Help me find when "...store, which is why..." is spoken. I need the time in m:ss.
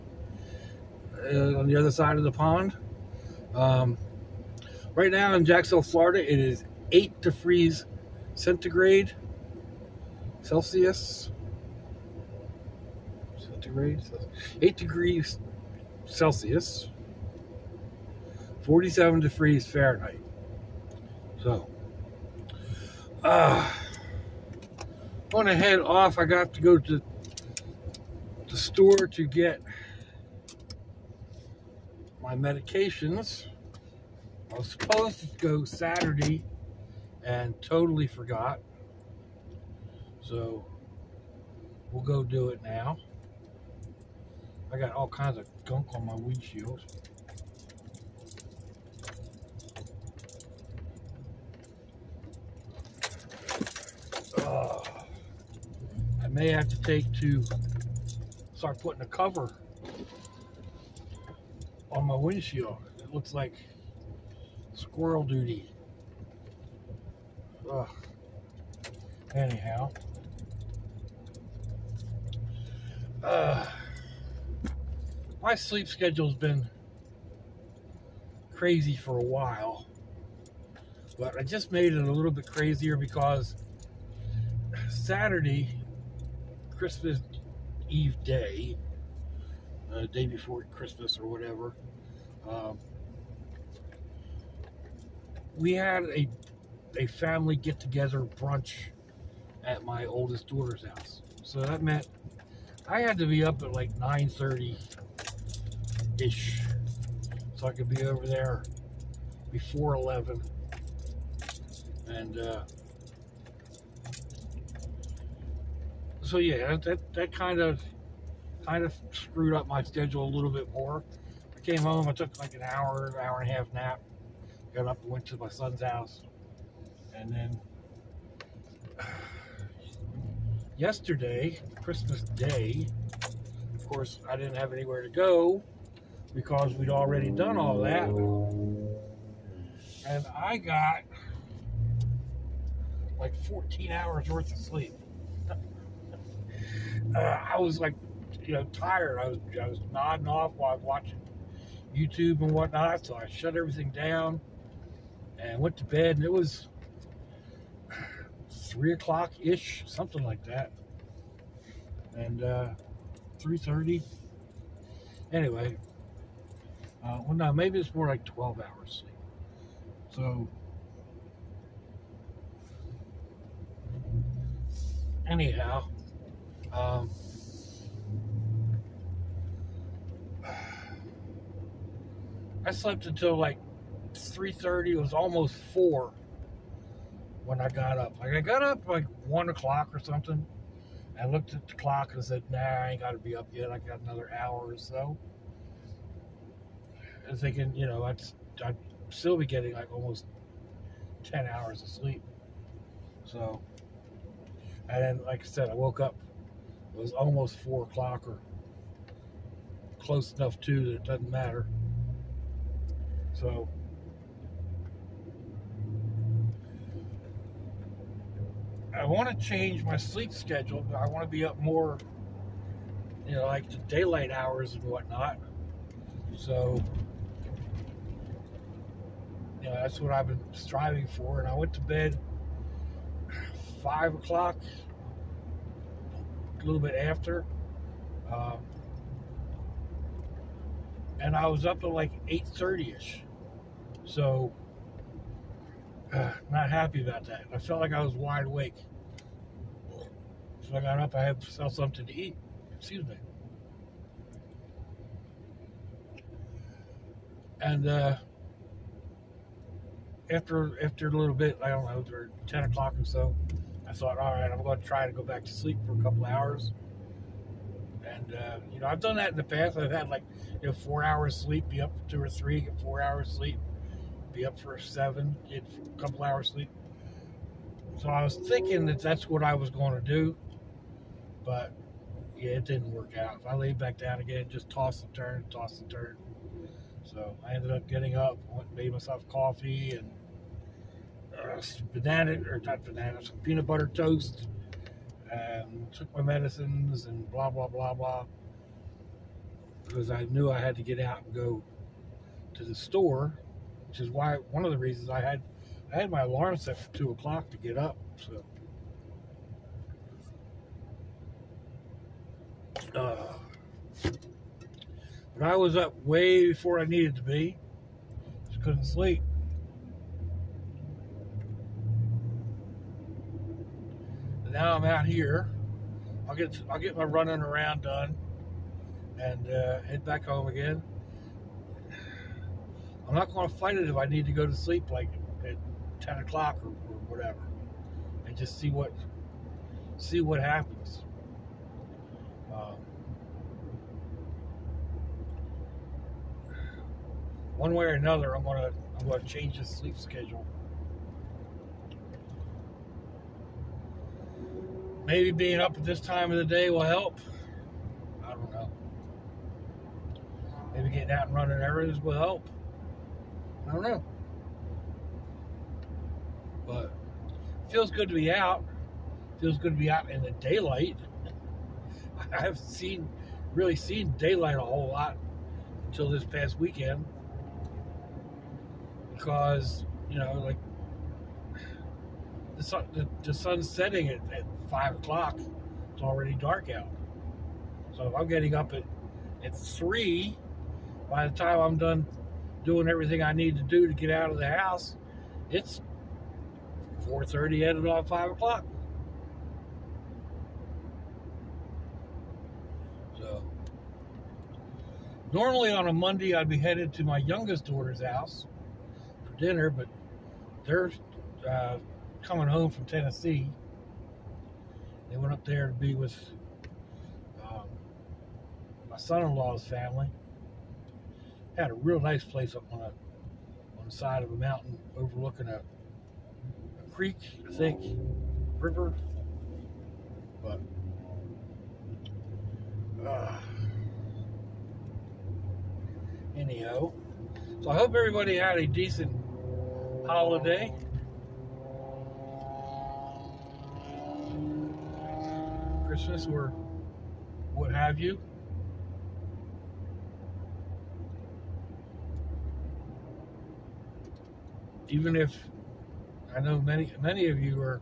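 5:02.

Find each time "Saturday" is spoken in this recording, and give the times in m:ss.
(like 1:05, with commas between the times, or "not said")
0:35, 1:24.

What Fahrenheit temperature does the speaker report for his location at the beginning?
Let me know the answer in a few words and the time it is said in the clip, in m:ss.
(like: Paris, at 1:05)
47 degrees, at 0:18.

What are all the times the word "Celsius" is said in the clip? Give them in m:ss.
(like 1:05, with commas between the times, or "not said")
0:10, 0:16.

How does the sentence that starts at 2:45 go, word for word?
Anyway, uh, well, now maybe it's more like twelve hours sleep.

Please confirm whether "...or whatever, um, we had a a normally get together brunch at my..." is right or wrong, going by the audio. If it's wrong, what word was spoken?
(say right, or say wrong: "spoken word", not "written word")
wrong: "family", not "normally".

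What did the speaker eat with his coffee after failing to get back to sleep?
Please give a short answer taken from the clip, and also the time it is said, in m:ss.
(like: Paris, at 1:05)
peanut butter toast, at 4:53.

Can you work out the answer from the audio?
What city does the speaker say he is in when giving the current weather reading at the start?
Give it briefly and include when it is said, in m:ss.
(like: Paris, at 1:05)
Jacksonville, Florida, at 0:05.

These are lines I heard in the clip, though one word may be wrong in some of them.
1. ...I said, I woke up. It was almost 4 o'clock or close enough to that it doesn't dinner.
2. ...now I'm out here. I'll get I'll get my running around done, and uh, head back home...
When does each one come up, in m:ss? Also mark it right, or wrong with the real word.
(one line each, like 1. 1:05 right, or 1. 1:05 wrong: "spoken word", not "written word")
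1. 3:25 wrong: "matter", not "dinner"
2. 5:24 right.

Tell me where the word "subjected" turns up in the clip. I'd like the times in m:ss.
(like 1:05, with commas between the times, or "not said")
not said.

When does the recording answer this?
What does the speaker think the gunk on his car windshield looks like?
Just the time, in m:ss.
1:04.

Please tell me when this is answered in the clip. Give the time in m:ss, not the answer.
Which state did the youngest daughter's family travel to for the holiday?
6:52.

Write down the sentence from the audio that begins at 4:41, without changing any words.
But yeah, it didn't work out.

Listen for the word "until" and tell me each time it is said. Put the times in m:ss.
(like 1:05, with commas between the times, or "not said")
3:03, 6:15.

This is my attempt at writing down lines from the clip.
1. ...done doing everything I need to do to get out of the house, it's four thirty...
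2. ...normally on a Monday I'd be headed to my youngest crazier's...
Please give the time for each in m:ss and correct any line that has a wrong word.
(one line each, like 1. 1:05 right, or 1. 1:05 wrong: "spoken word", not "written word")
1. 6:31 right
2. 6:45 wrong: "daughter", not "crazier".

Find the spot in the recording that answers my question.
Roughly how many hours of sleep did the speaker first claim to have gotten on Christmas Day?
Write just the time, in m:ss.
2:23.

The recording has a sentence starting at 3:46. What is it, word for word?
So, you know, that's what I've been striving for.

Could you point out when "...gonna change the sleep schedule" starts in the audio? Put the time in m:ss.
5:49.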